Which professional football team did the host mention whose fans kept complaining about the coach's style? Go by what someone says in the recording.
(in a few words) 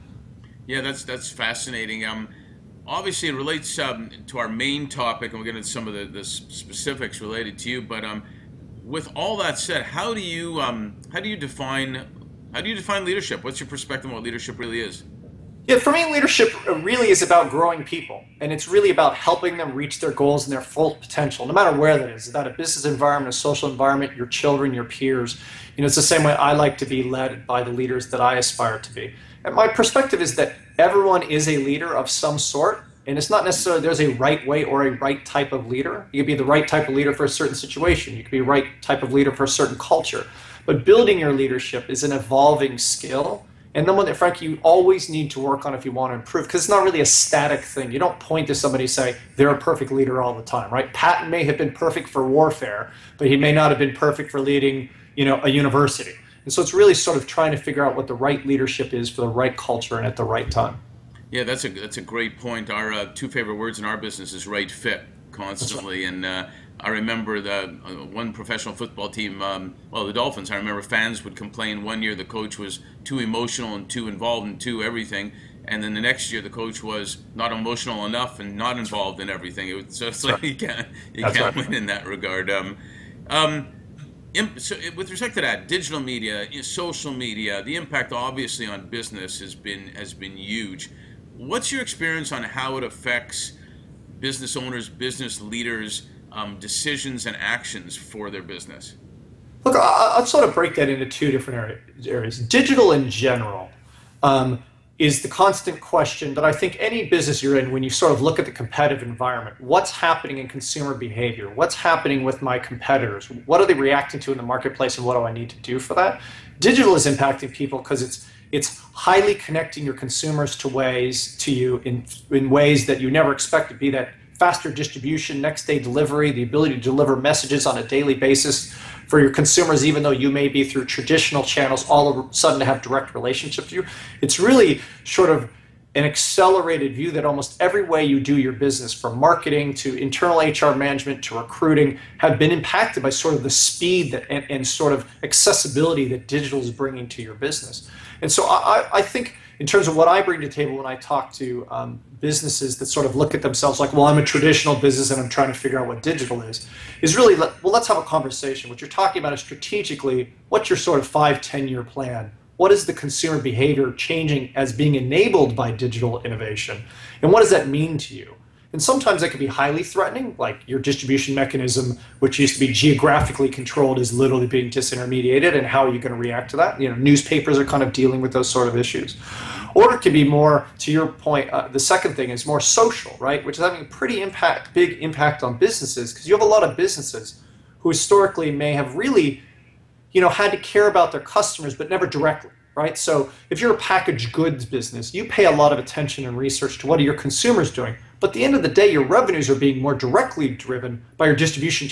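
the Dolphins.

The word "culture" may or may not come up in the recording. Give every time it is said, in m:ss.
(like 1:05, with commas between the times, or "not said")
0:39, 0:59.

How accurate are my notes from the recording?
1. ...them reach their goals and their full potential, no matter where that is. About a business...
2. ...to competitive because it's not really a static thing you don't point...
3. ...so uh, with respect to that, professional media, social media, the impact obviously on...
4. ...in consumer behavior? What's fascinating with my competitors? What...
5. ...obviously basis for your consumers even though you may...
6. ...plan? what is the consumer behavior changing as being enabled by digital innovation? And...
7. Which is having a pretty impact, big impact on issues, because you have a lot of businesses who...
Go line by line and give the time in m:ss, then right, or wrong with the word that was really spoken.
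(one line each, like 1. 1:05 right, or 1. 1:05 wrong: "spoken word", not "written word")
1. 0:19 right
2. 0:46 wrong: "improve", not "competitive"
3. 1:24 wrong: "digital", not "professional"
4. 1:50 wrong: "happening", not "fascinating"
5. 2:07 wrong: "daily", not "obviously"
6. 2:41 right
7. 3:03 wrong: "businesses", not "issues".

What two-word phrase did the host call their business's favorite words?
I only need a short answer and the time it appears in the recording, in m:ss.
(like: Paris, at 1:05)
right fit, at 1:04.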